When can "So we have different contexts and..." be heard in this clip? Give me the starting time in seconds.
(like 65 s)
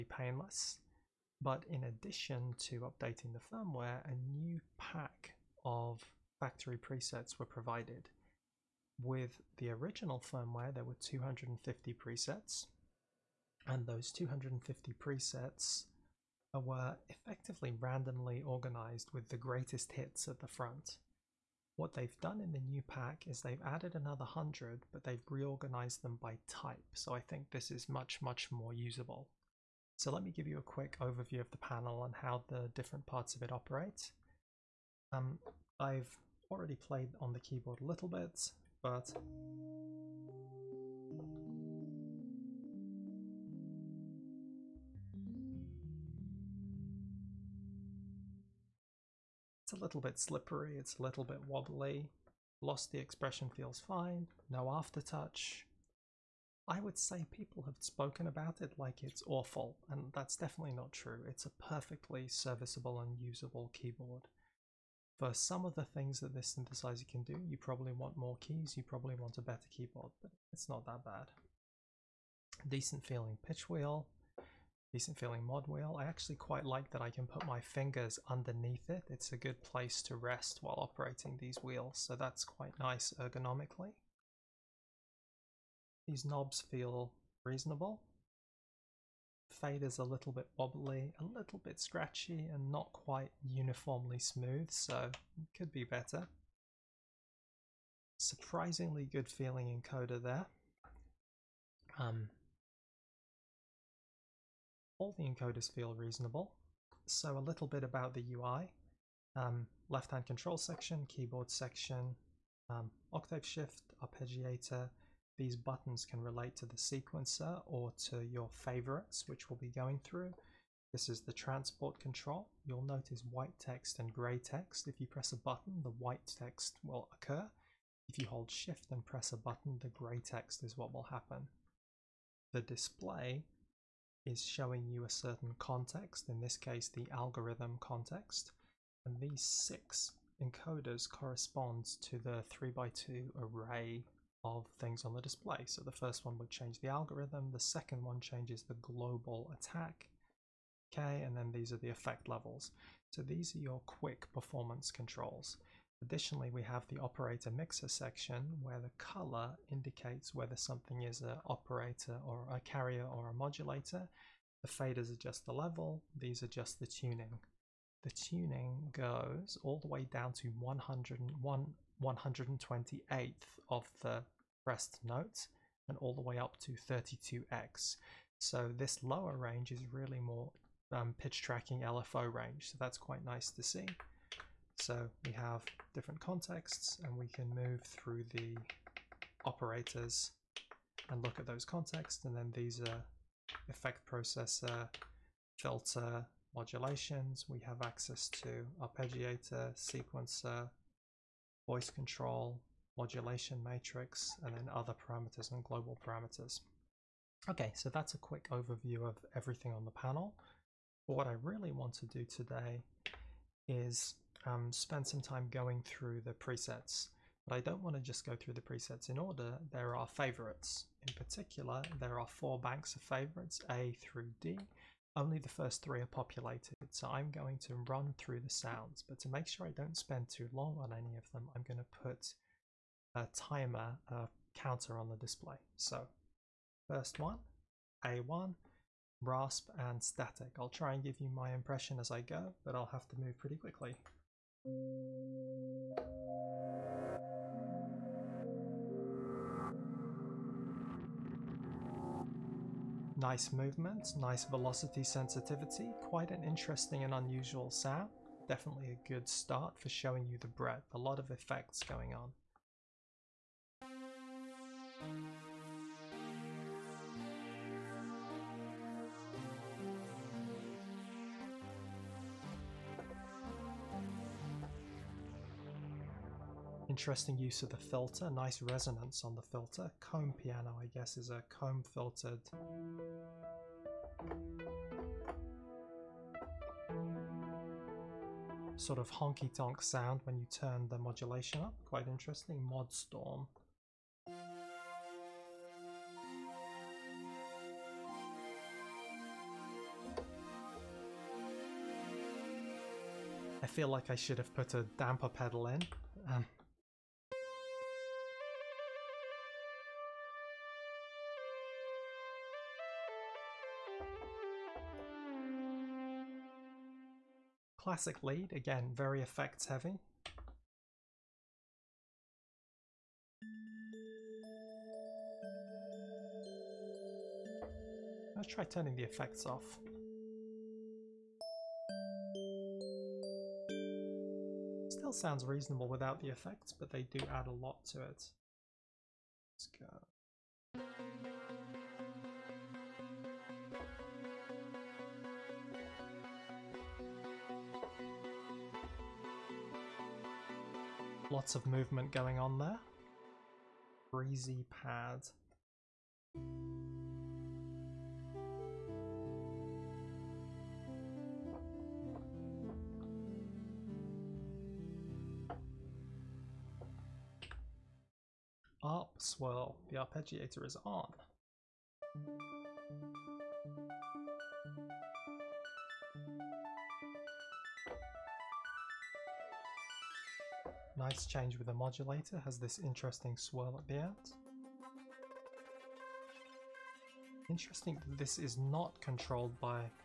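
184 s.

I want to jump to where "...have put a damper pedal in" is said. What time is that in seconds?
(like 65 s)
304 s.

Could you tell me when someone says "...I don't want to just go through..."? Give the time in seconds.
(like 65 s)
217 s.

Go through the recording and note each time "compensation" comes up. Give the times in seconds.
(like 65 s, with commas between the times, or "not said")
not said.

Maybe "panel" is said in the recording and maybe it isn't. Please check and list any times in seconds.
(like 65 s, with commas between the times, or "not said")
31 s, 209 s.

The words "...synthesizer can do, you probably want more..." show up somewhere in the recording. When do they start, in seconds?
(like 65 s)
66 s.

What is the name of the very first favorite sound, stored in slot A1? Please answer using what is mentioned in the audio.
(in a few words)
Rasp and Static.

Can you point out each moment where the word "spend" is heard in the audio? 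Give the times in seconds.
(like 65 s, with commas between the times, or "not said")
214 s, 229 s.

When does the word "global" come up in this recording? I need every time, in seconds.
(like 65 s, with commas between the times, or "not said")
148 s, 205 s.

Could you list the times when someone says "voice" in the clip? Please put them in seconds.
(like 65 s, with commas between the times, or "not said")
201 s.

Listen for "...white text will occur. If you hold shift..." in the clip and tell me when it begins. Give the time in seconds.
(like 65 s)
125 s.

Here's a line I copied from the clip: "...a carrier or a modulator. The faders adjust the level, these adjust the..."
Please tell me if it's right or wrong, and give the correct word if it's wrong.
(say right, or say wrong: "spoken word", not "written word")
right.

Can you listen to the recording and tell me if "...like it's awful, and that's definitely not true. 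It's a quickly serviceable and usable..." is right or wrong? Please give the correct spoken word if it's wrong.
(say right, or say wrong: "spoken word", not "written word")
wrong: "perfectly", not "quickly".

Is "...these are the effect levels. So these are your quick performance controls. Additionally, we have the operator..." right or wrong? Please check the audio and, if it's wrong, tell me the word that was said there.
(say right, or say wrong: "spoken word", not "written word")
right.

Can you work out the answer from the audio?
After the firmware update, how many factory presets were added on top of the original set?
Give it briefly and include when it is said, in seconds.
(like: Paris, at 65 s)
100, at 24 s.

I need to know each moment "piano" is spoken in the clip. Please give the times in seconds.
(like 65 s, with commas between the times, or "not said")
280 s.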